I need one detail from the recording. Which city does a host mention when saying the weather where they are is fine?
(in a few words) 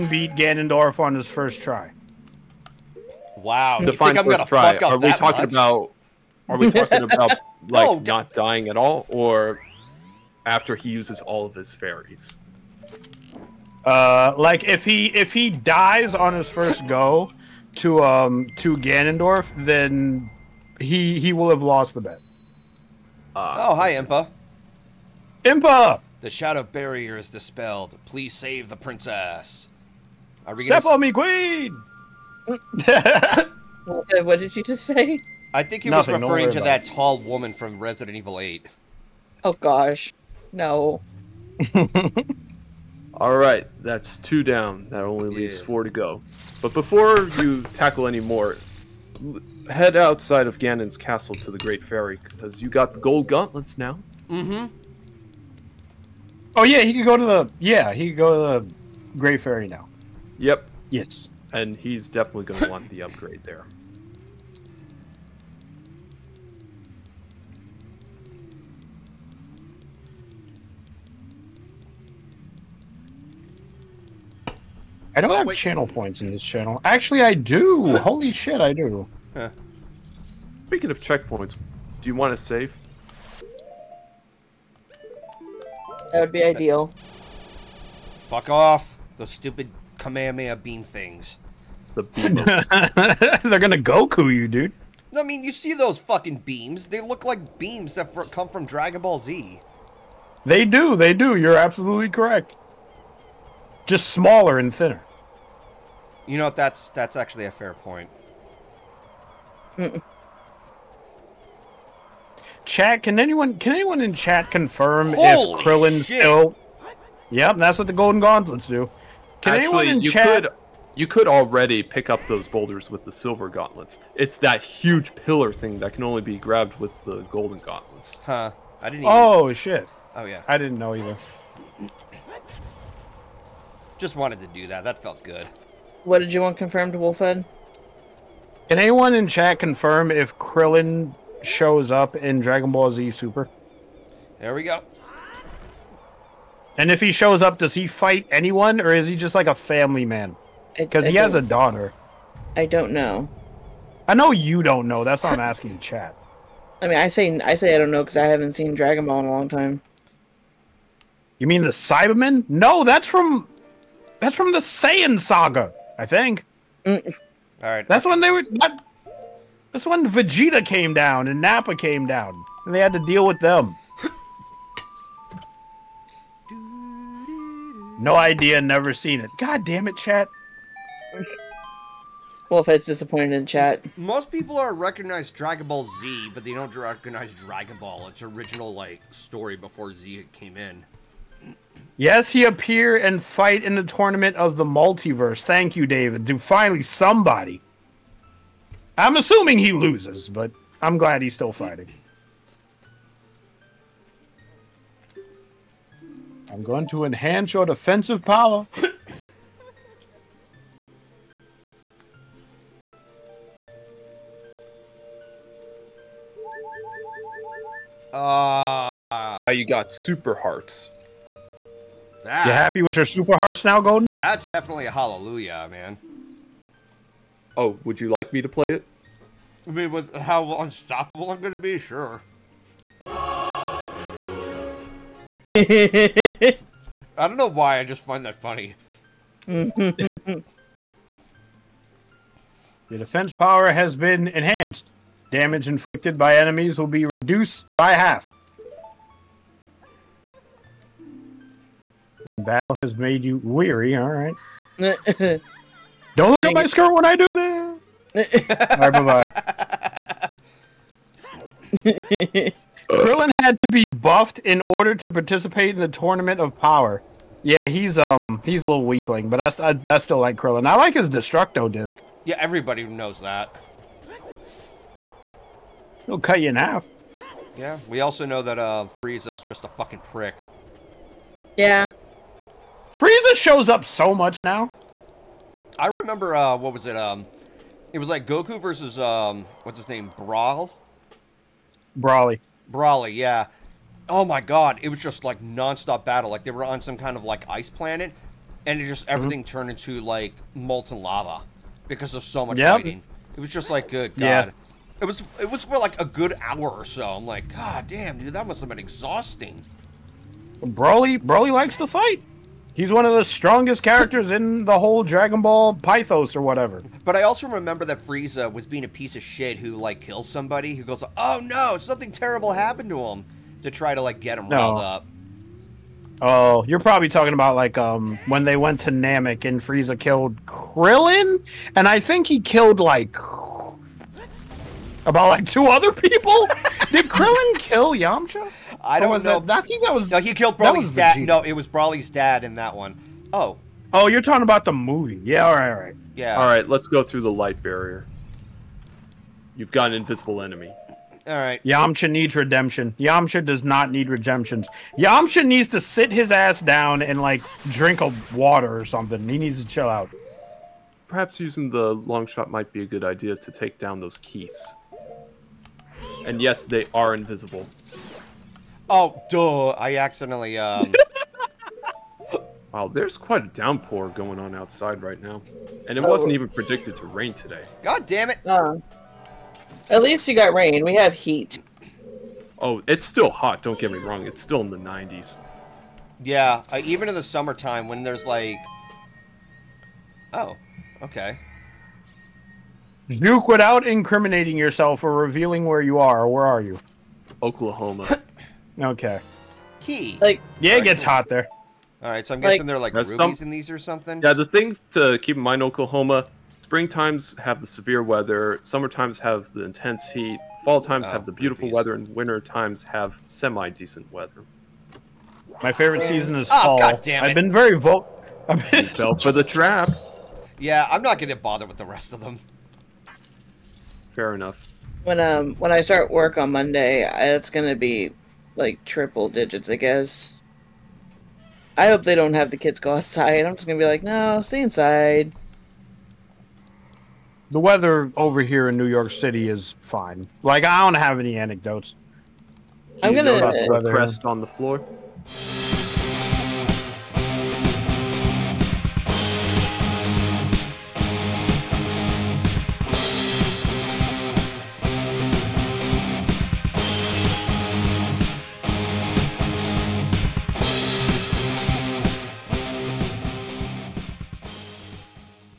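New York City.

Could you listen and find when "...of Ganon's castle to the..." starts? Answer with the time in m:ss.
0:50.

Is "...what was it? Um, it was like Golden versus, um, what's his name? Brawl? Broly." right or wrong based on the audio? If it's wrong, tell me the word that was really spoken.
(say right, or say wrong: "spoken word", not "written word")
wrong: "Goku", not "Golden".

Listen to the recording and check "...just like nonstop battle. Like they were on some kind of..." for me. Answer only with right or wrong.
right.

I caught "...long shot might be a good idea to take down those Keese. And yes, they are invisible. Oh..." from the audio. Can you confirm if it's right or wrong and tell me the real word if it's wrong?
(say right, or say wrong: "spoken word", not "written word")
right.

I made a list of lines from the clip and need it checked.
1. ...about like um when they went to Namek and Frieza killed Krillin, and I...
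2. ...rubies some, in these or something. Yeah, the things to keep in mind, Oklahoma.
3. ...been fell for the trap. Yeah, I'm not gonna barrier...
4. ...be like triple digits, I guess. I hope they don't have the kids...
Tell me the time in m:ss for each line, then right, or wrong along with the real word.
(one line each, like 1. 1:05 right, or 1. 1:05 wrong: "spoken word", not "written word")
1. 5:27 right
2. 6:42 right
3. 6:58 wrong: "bother", not "barrier"
4. 7:07 right.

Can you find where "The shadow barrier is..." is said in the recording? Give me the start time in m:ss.
0:26.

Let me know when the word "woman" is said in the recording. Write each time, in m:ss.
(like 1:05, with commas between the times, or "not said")
0:37.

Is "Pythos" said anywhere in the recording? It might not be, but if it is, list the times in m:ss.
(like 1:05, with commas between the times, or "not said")
5:15.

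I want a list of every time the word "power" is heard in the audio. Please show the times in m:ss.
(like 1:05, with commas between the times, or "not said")
3:28, 4:03, 4:26.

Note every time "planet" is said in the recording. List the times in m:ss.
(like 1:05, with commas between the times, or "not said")
4:57.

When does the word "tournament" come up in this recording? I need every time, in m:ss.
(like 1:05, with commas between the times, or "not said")
3:13, 4:25.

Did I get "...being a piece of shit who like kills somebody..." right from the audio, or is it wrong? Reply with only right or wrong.
right.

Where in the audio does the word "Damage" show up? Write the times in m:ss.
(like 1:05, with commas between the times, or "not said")
4:05.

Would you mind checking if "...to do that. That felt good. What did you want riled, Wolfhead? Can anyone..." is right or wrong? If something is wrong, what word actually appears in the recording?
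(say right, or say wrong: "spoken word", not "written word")
wrong: "confirmed", not "riled".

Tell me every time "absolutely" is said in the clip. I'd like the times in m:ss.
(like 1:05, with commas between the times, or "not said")
1:41.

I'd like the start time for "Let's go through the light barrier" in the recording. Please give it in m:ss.
5:46.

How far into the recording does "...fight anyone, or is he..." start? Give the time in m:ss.
2:27.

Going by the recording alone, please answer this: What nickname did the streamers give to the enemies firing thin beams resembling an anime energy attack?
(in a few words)
The beamers.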